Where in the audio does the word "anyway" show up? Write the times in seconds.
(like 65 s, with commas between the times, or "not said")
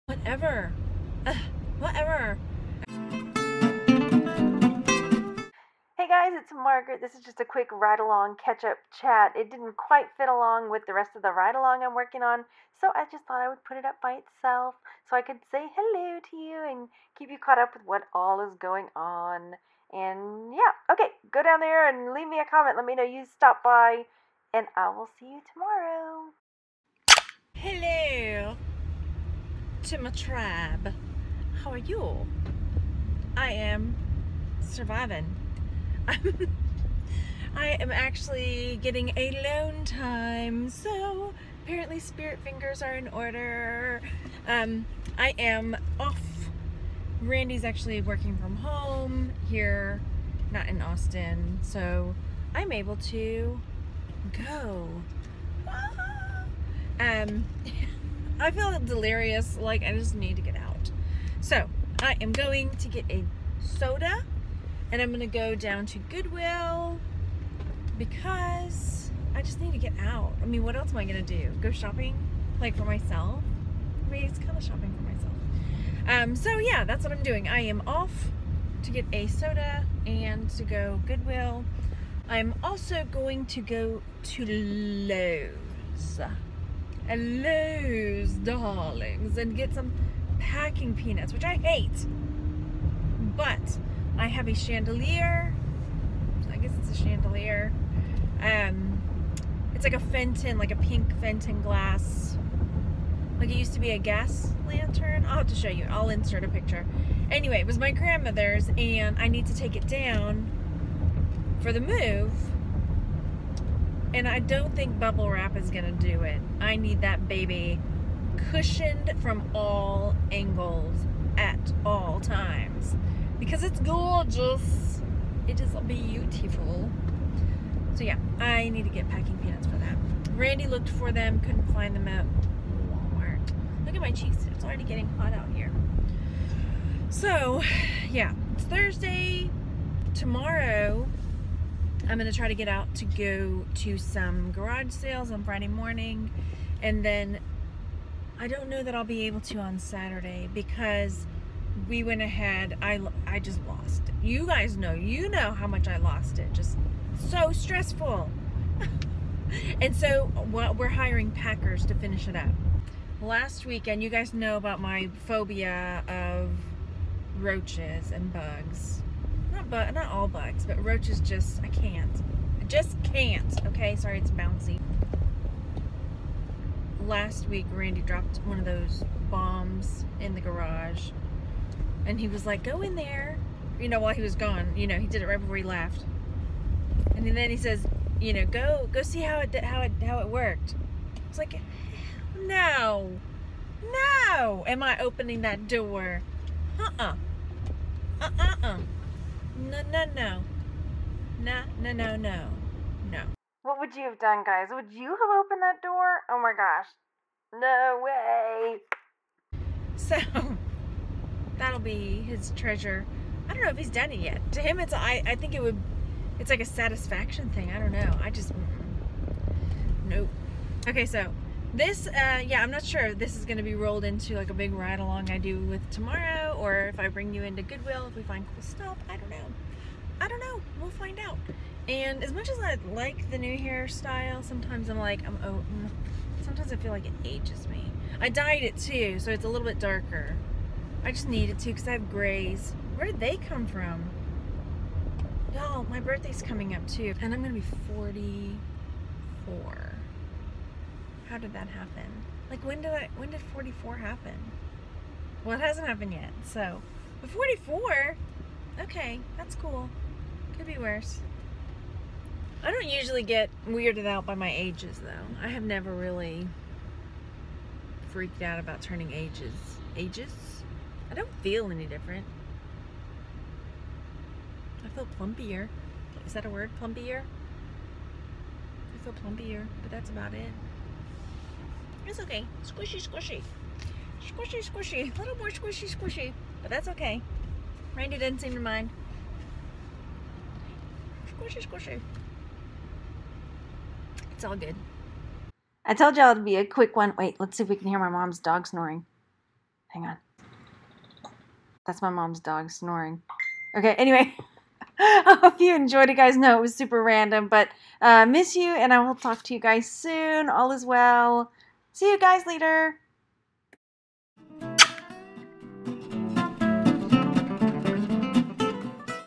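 107 s, 303 s.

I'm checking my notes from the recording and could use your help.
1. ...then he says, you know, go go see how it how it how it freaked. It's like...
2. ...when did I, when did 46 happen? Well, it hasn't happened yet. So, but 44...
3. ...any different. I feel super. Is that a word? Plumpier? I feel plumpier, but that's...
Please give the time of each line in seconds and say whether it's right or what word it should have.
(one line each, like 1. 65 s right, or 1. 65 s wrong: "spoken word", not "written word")
1. 187 s wrong: "worked", not "freaked"
2. 252 s wrong: "44", not "46"
3. 271 s wrong: "plumpier", not "super".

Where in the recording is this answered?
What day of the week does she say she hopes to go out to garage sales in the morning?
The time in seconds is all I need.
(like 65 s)
145 s.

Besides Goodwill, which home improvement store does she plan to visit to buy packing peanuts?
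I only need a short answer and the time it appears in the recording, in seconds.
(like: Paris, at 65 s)
Lowe's, at 84 s.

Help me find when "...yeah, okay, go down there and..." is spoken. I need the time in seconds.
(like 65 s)
20 s.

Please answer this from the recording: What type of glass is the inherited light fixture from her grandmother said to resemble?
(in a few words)
Pink Fenton glass.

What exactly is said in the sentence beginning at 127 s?
So yeah, I need to get packing peanuts for that.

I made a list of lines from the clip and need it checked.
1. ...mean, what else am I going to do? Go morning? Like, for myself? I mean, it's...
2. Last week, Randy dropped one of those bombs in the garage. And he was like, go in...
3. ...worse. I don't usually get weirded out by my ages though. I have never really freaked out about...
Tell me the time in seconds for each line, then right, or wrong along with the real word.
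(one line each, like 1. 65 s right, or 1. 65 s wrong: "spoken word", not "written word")
1. 70 s wrong: "shopping", not "morning"
2. 177 s right
3. 260 s right.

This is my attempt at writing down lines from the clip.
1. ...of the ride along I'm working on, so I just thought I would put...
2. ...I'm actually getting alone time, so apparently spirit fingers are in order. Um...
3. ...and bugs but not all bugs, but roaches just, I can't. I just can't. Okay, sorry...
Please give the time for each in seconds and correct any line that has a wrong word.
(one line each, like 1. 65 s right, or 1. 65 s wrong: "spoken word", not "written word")
1. 11 s right
2. 37 s right
3. 168 s right.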